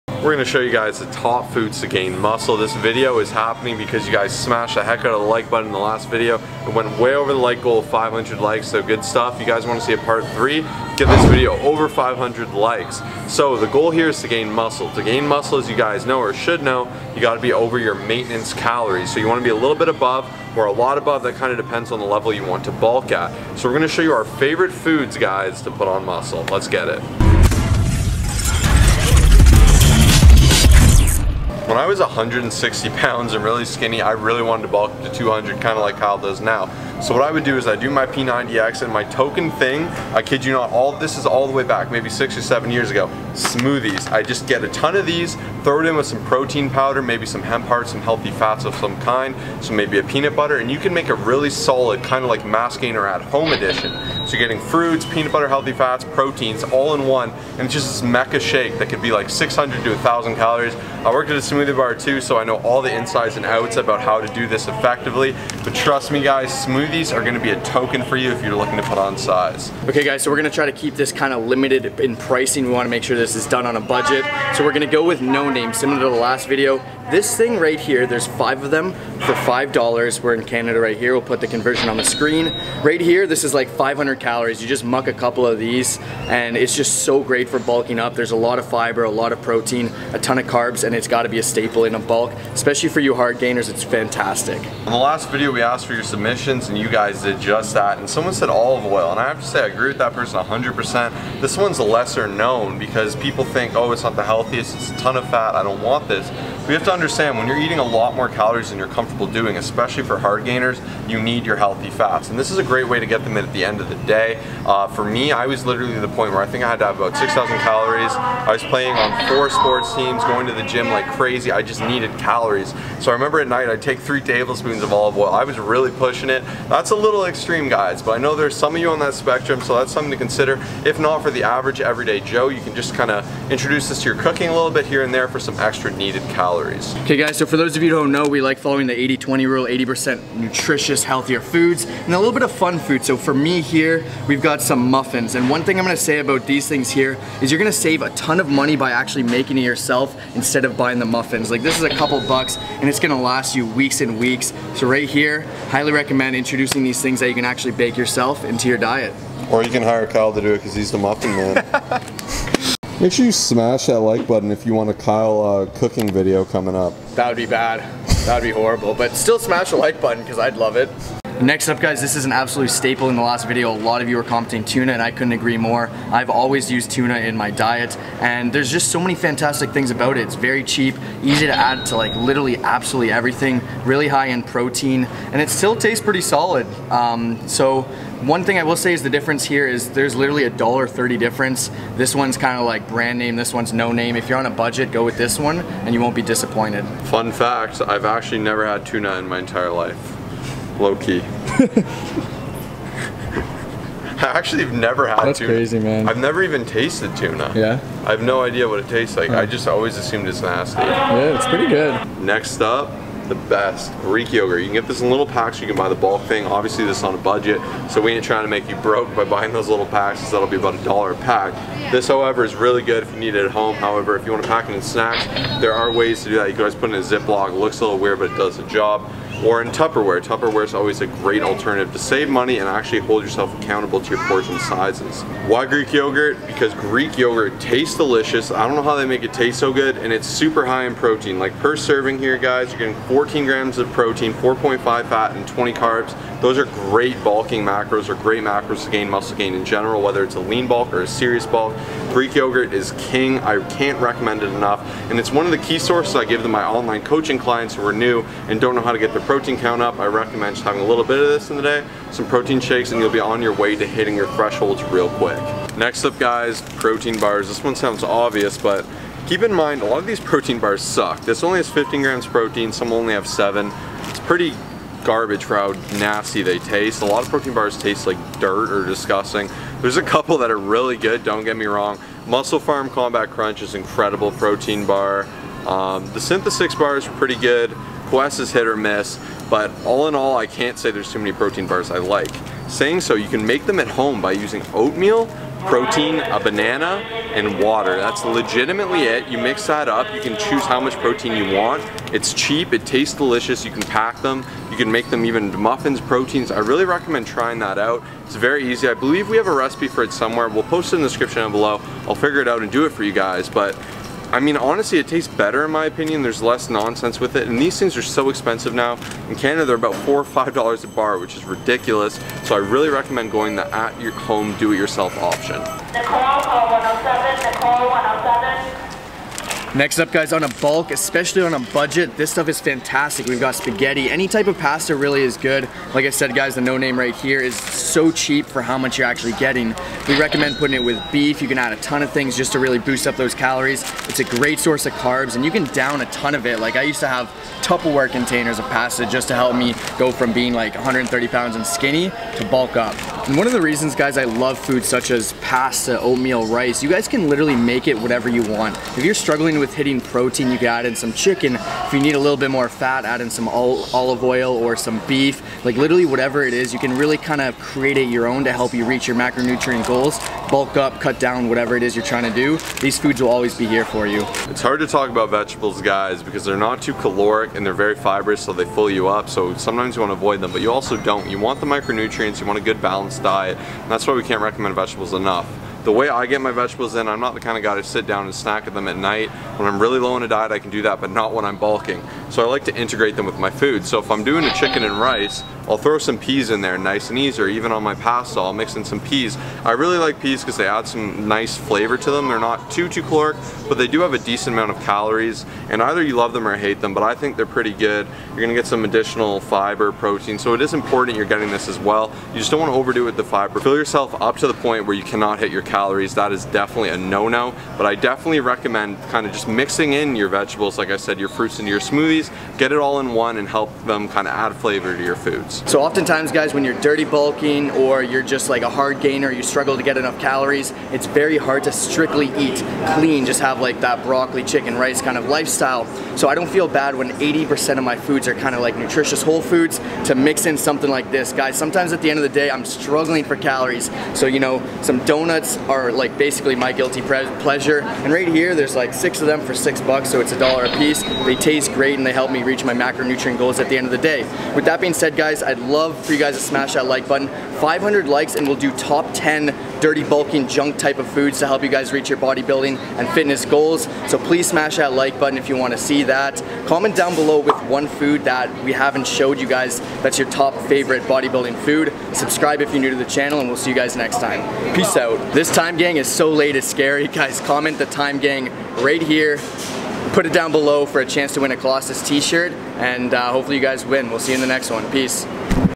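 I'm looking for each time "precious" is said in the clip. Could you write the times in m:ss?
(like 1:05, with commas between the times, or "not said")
not said.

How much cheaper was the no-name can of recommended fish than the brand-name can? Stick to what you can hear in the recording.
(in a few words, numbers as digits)
$1.30.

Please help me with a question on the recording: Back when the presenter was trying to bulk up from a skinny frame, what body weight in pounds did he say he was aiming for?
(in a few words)
200.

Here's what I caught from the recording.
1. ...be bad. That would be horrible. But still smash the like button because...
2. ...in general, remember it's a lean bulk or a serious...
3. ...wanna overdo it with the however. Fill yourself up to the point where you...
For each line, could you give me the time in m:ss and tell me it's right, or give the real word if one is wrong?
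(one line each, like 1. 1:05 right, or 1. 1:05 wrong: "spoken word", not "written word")
1. 2:47 right
2. 4:09 wrong: "whether", not "remember"
3. 6:52 wrong: "fiber", not "however".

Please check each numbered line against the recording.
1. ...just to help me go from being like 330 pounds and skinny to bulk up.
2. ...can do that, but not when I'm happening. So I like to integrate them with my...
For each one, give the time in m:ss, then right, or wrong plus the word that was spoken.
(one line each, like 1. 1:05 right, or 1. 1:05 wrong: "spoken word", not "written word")
1. 5:49 wrong: "130", not "330"
2. 6:30 wrong: "bulking", not "happening".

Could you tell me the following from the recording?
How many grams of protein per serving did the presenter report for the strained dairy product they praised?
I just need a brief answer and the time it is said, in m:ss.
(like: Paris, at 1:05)
14, at 4:03.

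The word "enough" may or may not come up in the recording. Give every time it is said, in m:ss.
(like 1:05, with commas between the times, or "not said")
4:14, 6:25, 7:09.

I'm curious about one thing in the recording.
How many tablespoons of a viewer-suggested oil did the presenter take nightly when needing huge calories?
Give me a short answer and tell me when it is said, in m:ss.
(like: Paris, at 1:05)
3, at 2:03.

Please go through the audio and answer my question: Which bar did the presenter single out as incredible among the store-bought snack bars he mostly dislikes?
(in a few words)
MusclePharm Combat Crunch.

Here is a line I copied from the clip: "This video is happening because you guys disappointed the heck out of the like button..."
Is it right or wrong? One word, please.
wrong.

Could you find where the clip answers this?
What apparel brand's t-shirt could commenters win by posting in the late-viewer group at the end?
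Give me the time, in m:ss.
8:01.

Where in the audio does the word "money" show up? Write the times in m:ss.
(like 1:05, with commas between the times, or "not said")
2:28, 3:52.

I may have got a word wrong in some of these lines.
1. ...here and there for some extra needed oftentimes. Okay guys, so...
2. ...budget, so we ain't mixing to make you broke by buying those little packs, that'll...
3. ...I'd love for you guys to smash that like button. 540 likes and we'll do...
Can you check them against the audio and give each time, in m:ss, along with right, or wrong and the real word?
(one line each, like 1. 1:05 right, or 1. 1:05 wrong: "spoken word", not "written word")
1. 2:14 wrong: "calories", not "oftentimes"
2. 3:37 wrong: "trying", not "mixing"
3. 7:35 wrong: "500", not "540".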